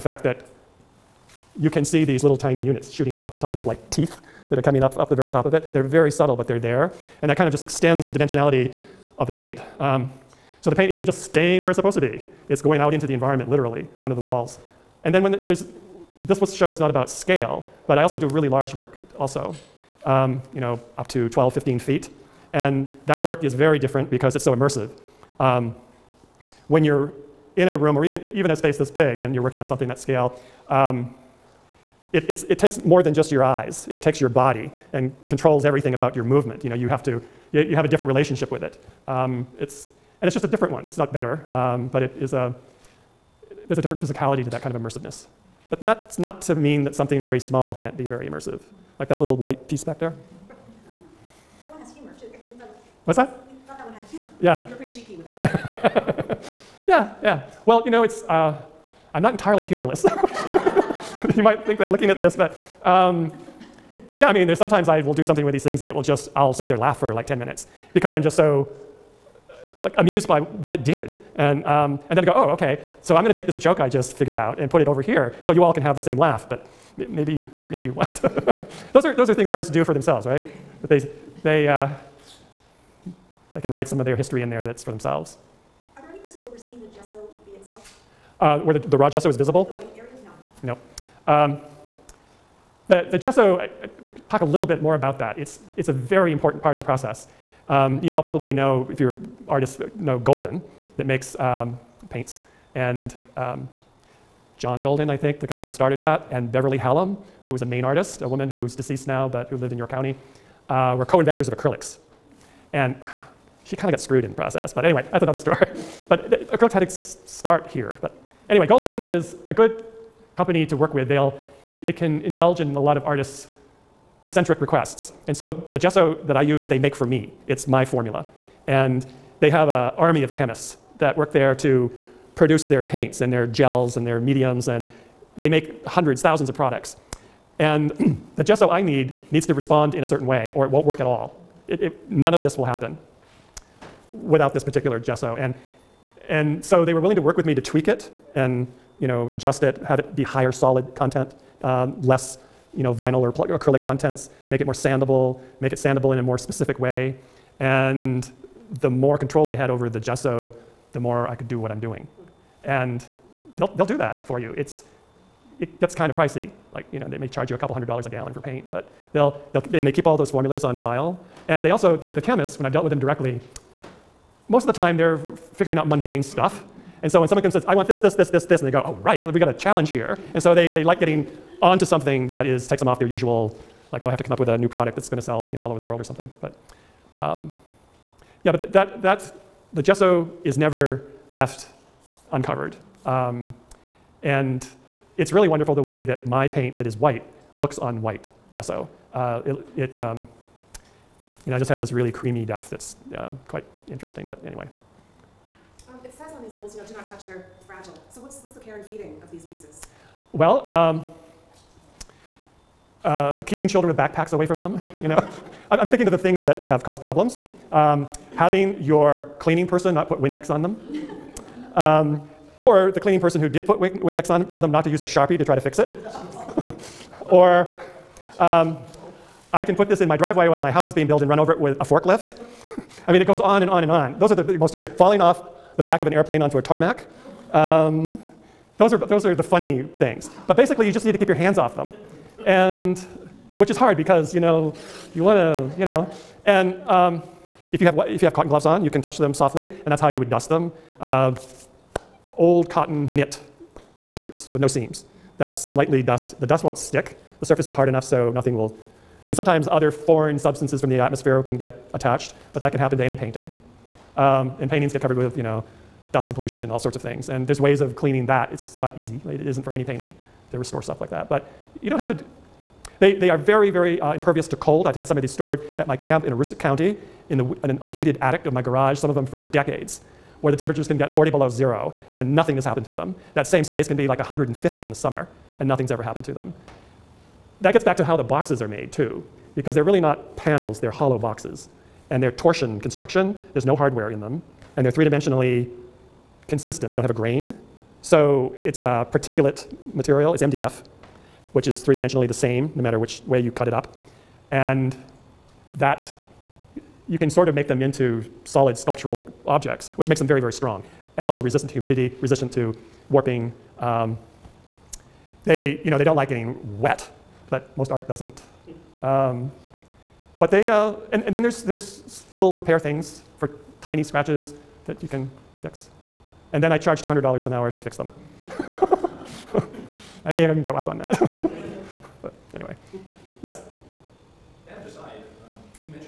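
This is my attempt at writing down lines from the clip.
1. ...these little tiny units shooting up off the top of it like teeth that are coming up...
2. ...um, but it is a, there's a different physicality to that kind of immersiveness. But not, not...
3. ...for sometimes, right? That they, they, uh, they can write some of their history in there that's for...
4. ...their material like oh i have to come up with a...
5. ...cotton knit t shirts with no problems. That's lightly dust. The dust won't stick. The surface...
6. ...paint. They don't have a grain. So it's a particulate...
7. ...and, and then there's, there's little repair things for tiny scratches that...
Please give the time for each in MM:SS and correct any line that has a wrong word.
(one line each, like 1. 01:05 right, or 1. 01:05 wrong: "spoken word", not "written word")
1. 00:02 right
2. 00:41 right
3. 01:19 wrong: "themselves", not "sometimes"
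4. 03:02 wrong: "usual", not "material"
5. 04:12 wrong: "seams", not "problems"
6. 04:56 wrong: "consistent", not "paint"
7. 05:21 right.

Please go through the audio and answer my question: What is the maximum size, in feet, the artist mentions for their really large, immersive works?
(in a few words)
15 feet.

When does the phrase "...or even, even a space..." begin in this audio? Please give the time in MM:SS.
00:27.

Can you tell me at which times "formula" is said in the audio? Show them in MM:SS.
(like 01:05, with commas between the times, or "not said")
02:07, 02:50.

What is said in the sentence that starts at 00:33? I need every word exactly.
It takes your body and controls everything about your movement.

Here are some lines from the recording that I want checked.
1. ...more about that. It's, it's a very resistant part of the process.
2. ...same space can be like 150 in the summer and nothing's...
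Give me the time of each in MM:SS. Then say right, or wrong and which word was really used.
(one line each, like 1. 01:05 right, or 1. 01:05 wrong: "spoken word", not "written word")
1. 01:34 wrong: "important", not "resistant"
2. 04:43 right.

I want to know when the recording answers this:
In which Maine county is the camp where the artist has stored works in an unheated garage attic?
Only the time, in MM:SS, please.
04:36.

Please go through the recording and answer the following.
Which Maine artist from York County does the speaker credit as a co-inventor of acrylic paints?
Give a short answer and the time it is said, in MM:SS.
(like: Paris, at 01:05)
Beverly Hallam, at 01:46.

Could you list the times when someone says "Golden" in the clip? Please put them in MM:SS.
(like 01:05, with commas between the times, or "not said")
01:40, 01:44, 01:58.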